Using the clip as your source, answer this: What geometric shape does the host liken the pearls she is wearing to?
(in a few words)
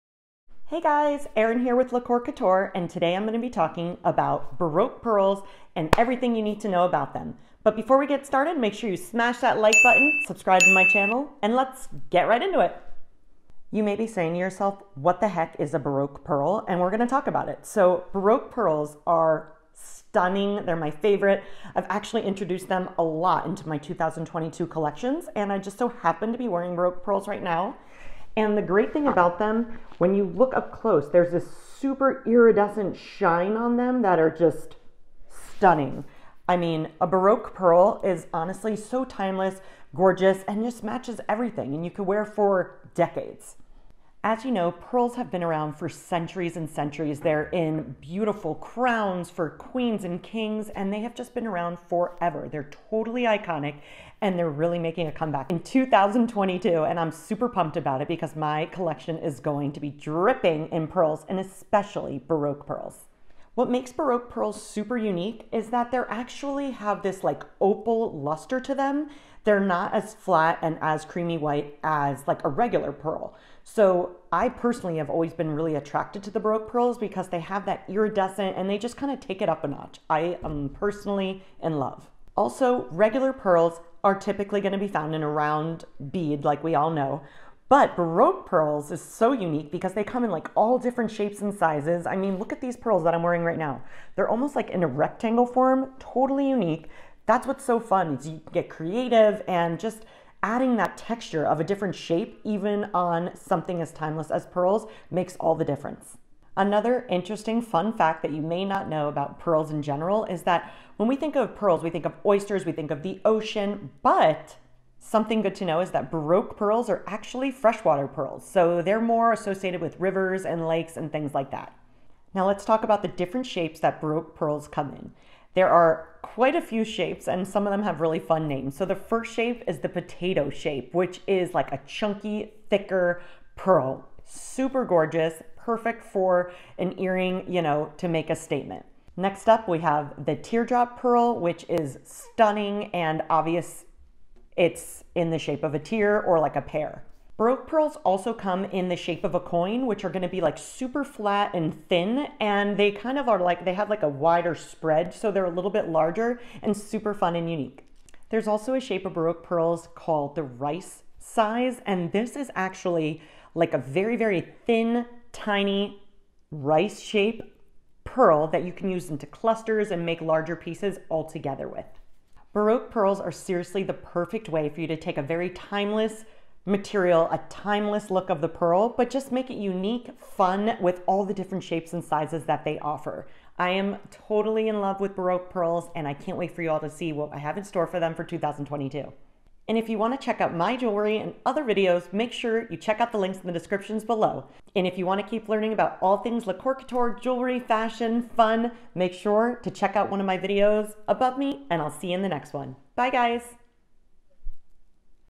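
Rectangle.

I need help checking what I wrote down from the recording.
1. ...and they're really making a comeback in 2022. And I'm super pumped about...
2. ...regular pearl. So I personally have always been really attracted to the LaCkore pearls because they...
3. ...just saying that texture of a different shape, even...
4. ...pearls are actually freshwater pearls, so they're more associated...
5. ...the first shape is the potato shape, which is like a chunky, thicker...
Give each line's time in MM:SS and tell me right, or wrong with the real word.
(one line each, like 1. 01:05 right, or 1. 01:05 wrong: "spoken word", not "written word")
1. 00:54 right
2. 01:12 wrong: "Baroque", not "LaCkore"
3. 01:39 wrong: "adding", not "saying"
4. 01:56 right
5. 02:08 right.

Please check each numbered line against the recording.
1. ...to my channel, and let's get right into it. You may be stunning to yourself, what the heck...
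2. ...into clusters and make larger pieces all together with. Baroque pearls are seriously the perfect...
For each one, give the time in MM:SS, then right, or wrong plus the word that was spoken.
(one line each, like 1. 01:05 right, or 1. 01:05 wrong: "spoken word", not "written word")
1. 00:10 wrong: "saying", not "stunning"
2. 02:49 right.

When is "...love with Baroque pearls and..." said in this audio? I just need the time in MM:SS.
03:04.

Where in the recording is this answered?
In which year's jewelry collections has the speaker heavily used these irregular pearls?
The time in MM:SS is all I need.
00:23.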